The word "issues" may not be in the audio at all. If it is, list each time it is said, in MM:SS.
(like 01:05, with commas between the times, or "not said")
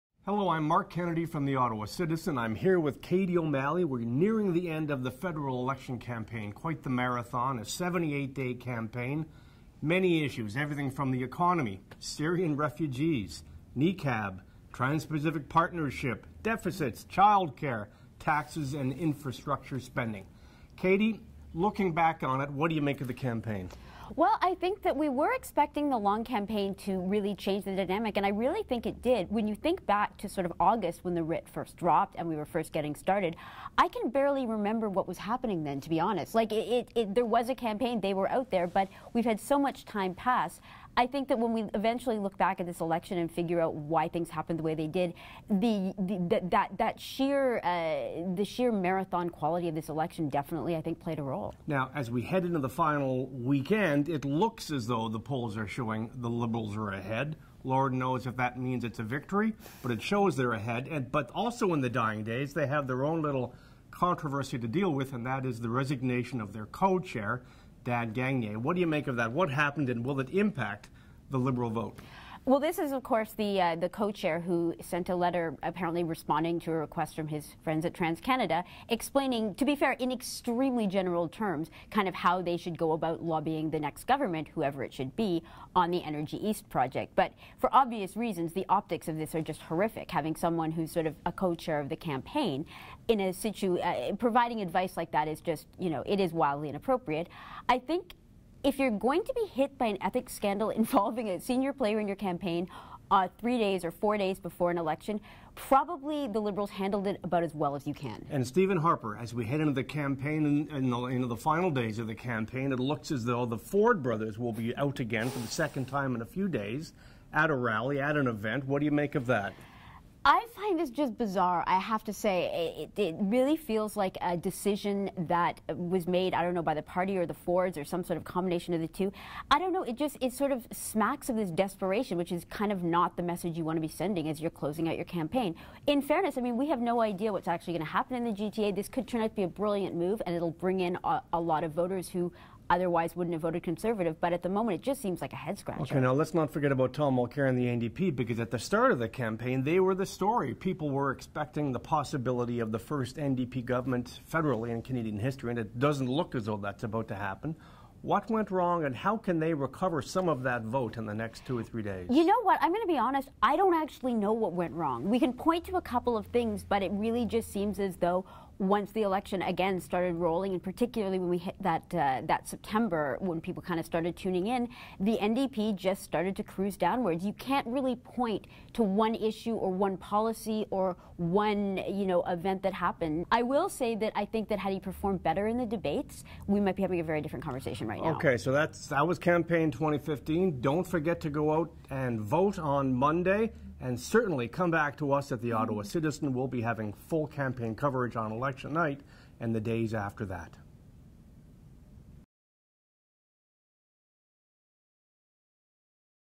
00:10, 02:59.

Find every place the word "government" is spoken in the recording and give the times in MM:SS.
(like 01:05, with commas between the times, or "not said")
01:24, 02:33.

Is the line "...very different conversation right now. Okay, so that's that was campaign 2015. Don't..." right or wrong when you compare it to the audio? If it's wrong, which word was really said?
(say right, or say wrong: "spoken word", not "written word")
right.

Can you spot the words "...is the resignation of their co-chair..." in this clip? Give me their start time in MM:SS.
01:05.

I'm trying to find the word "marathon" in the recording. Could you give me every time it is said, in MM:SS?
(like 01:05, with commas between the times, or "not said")
00:06, 00:48.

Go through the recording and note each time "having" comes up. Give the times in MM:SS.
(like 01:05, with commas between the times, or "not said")
01:30, 03:06, 03:16.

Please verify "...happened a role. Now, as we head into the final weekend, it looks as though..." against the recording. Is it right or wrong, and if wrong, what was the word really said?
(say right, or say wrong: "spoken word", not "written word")
wrong: "played", not "happened".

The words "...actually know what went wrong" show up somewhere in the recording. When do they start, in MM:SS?
02:43.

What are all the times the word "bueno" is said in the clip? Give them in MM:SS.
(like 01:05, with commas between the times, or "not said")
not said.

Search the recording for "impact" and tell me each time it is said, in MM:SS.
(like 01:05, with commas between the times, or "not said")
01:10.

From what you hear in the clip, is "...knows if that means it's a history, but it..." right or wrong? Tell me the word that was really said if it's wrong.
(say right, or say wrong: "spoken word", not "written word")
wrong: "victory", not "history".